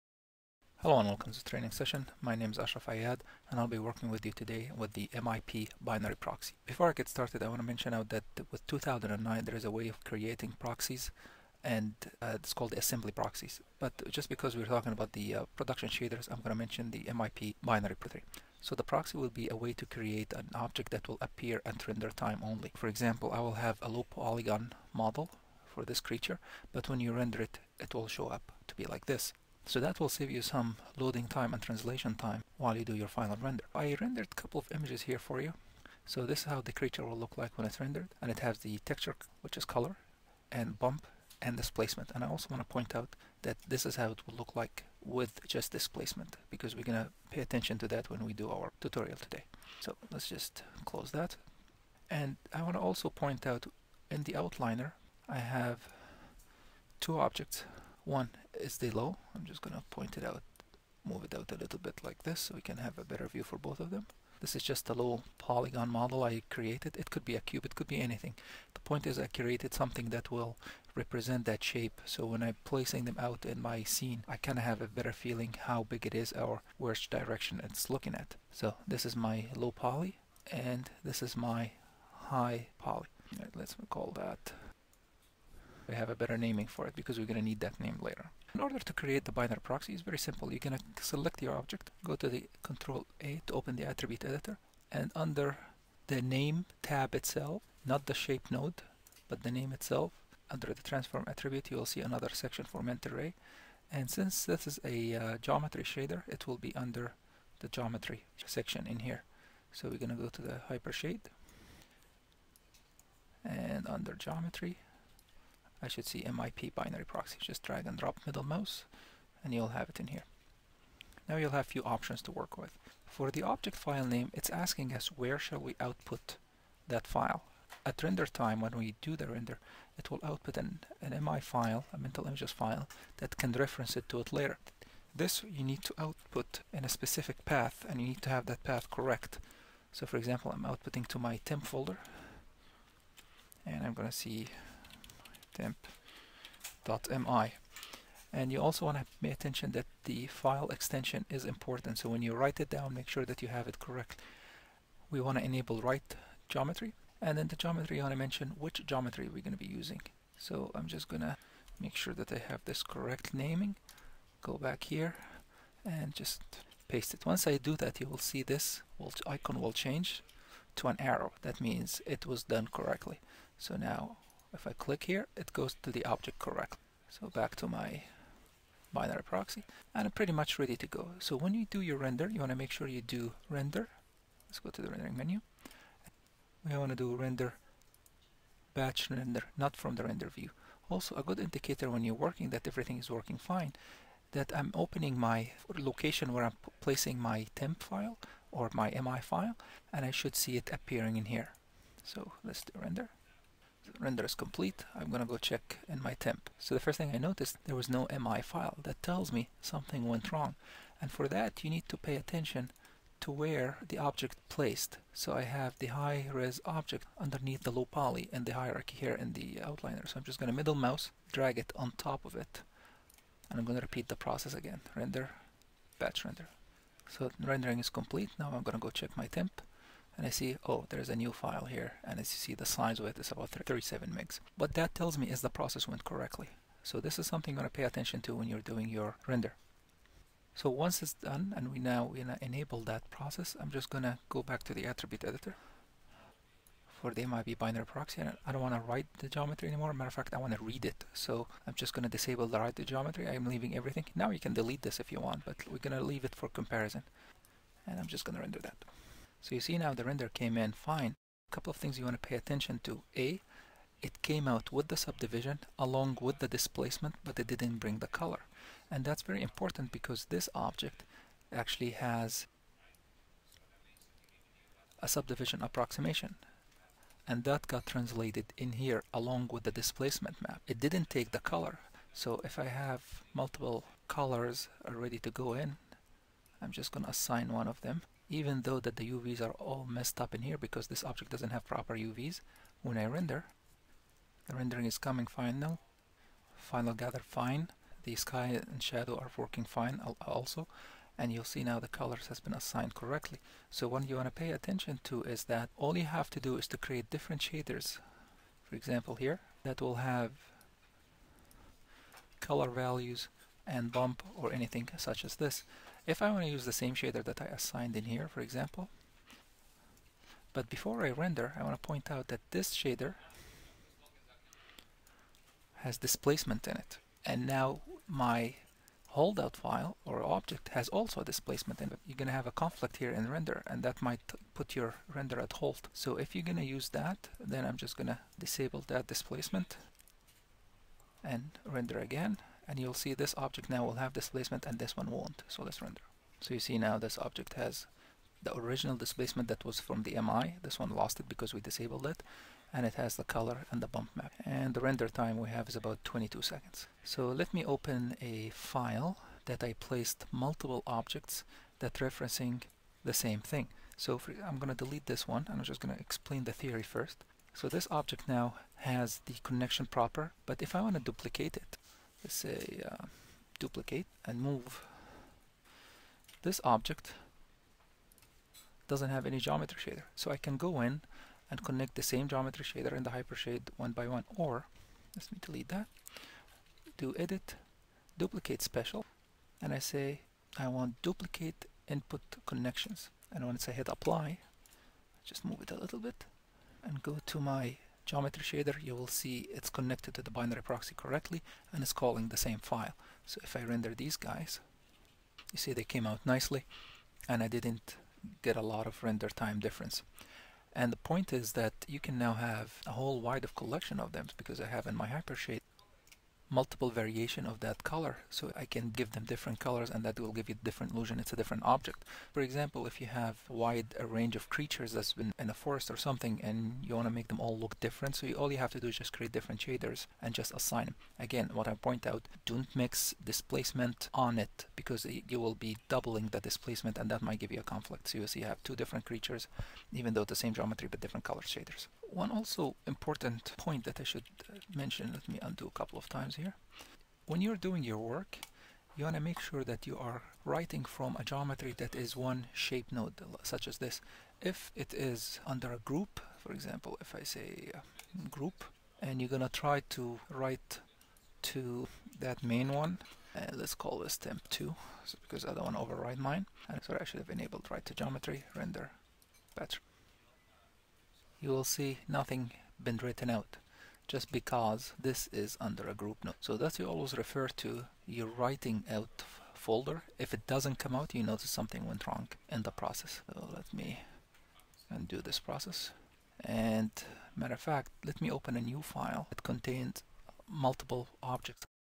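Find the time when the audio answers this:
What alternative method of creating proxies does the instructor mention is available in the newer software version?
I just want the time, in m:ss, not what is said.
0:12.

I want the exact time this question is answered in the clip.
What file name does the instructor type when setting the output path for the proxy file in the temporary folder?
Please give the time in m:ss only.
2:25.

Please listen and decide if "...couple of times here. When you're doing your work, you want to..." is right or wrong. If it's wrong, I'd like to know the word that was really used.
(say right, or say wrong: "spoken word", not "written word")
right.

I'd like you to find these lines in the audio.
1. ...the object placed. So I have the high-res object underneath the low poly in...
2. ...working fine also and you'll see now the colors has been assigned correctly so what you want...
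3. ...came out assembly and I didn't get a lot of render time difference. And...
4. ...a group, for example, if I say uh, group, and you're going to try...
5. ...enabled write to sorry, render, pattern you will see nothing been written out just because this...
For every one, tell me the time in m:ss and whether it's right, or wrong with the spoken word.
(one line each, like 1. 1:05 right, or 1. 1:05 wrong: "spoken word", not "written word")
1. 3:33 right
2. 4:59 right
3. 6:45 wrong: "nicely", not "assembly"
4. 7:35 right
5. 7:47 wrong: "geometry", not "sorry".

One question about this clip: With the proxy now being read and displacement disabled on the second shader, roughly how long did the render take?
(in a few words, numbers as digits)
22 seconds.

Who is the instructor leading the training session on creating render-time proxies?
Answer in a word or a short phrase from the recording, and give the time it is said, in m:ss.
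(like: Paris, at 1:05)
Ashraf Aiad, at 0:02.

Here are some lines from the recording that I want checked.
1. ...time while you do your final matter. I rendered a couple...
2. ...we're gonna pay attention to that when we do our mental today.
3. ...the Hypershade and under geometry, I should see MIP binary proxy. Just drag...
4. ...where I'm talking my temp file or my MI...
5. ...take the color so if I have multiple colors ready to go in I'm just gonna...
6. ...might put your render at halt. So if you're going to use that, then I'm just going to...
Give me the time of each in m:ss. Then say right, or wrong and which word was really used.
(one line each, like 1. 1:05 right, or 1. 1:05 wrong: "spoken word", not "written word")
1. 0:32 wrong: "render", not "matter"
2. 0:46 wrong: "tutorial", not "mental"
3. 1:50 right
4. 3:16 wrong: "placing", not "talking"
5. 4:41 right
6. 5:34 right.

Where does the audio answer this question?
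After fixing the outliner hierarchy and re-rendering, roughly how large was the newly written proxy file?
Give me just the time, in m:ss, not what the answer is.
3:53.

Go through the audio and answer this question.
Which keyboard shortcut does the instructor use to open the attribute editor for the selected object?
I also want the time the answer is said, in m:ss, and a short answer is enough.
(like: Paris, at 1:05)
Control A, at 1:32.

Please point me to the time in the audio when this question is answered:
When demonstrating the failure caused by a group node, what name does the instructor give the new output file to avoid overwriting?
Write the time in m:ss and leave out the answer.
7:44.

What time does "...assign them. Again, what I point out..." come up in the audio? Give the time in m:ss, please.
7:10.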